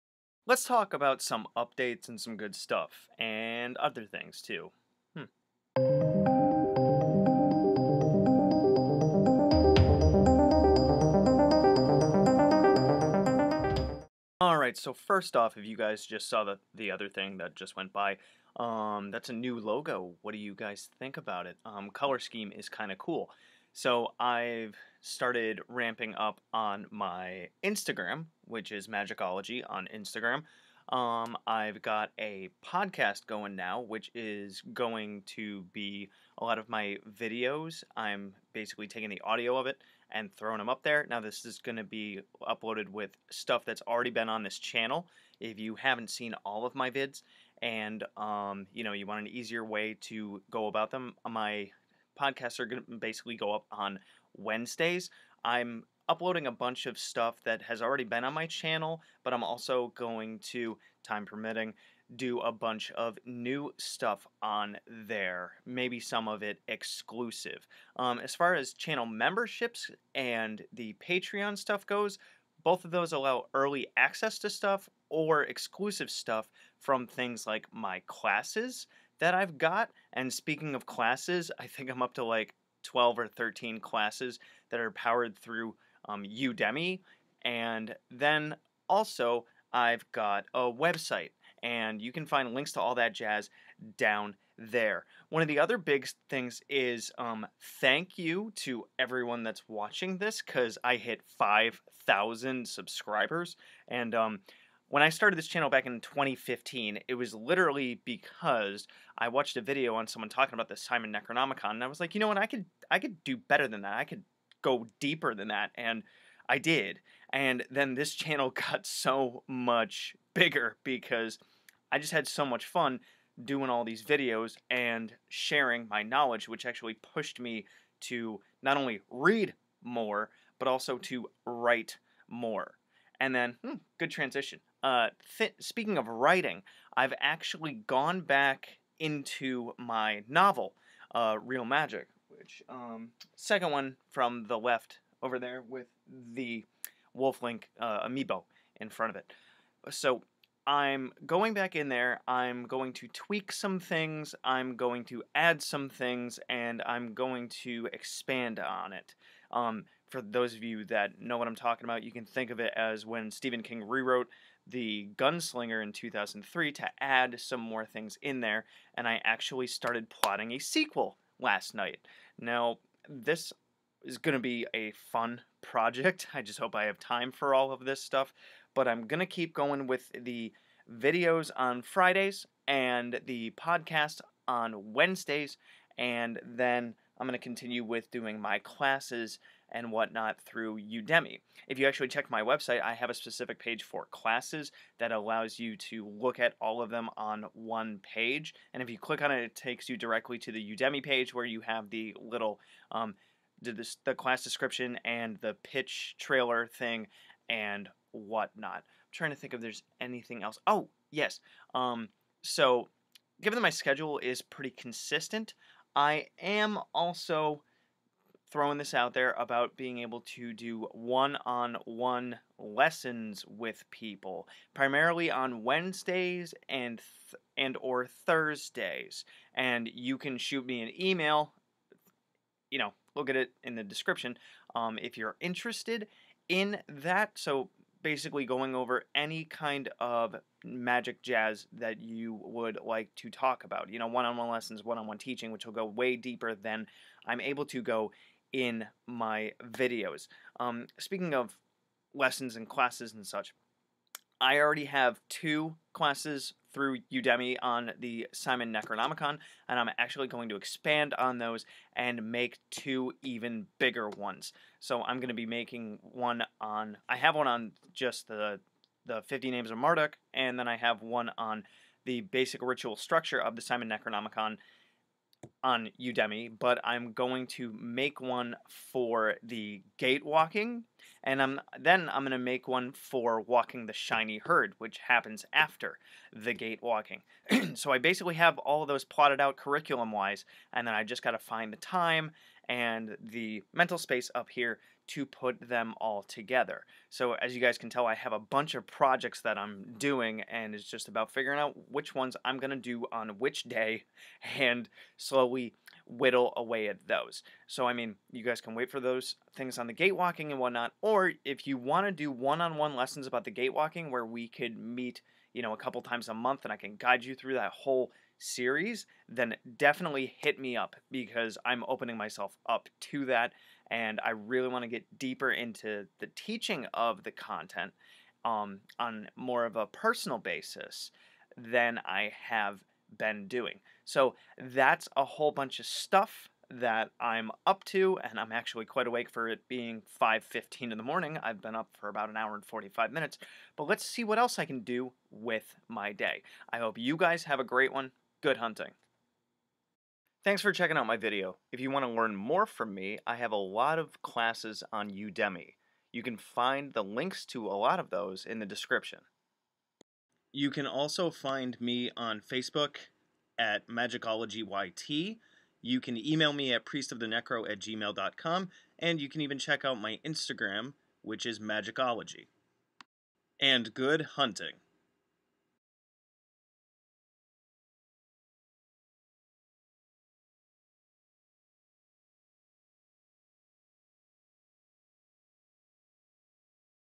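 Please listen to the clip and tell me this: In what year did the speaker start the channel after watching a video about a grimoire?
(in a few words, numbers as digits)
2015.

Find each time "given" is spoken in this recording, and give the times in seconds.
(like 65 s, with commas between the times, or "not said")
213 s.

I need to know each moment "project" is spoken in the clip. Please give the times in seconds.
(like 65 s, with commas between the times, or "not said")
175 s, 298 s.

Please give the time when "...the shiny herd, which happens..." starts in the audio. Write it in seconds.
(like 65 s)
283 s.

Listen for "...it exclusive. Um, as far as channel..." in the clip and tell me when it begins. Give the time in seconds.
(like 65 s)
66 s.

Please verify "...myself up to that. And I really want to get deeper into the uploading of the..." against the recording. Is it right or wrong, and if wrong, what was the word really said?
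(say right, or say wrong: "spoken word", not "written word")
wrong: "teaching", not "uploading".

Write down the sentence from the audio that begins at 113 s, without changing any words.
I could go deeper than that, and I did.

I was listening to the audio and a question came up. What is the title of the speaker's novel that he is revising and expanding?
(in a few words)
Real Magic.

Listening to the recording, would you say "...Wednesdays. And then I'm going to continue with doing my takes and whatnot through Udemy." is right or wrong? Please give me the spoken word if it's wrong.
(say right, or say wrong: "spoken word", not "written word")
wrong: "classes", not "takes".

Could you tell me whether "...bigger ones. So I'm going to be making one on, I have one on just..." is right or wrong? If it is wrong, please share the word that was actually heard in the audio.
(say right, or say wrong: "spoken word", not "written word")
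right.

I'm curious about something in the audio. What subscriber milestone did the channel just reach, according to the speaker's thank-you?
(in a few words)
5,000.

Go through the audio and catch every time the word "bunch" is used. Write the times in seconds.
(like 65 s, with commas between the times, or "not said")
56 s, 62 s, 298 s, 335 s.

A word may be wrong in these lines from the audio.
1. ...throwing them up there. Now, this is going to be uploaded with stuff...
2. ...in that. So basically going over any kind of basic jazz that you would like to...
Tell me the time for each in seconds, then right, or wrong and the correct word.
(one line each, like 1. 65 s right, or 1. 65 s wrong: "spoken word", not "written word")
1. 40 s right
2. 236 s wrong: "magic", not "basic".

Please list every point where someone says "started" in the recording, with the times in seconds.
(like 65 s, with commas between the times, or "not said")
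24 s, 105 s, 169 s.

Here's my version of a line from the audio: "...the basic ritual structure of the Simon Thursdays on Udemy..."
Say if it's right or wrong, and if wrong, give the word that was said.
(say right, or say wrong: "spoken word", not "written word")
wrong: "Necronomicon", not "Thursdays".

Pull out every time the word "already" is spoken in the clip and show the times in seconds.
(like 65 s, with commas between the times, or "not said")
43 s, 57 s, 254 s.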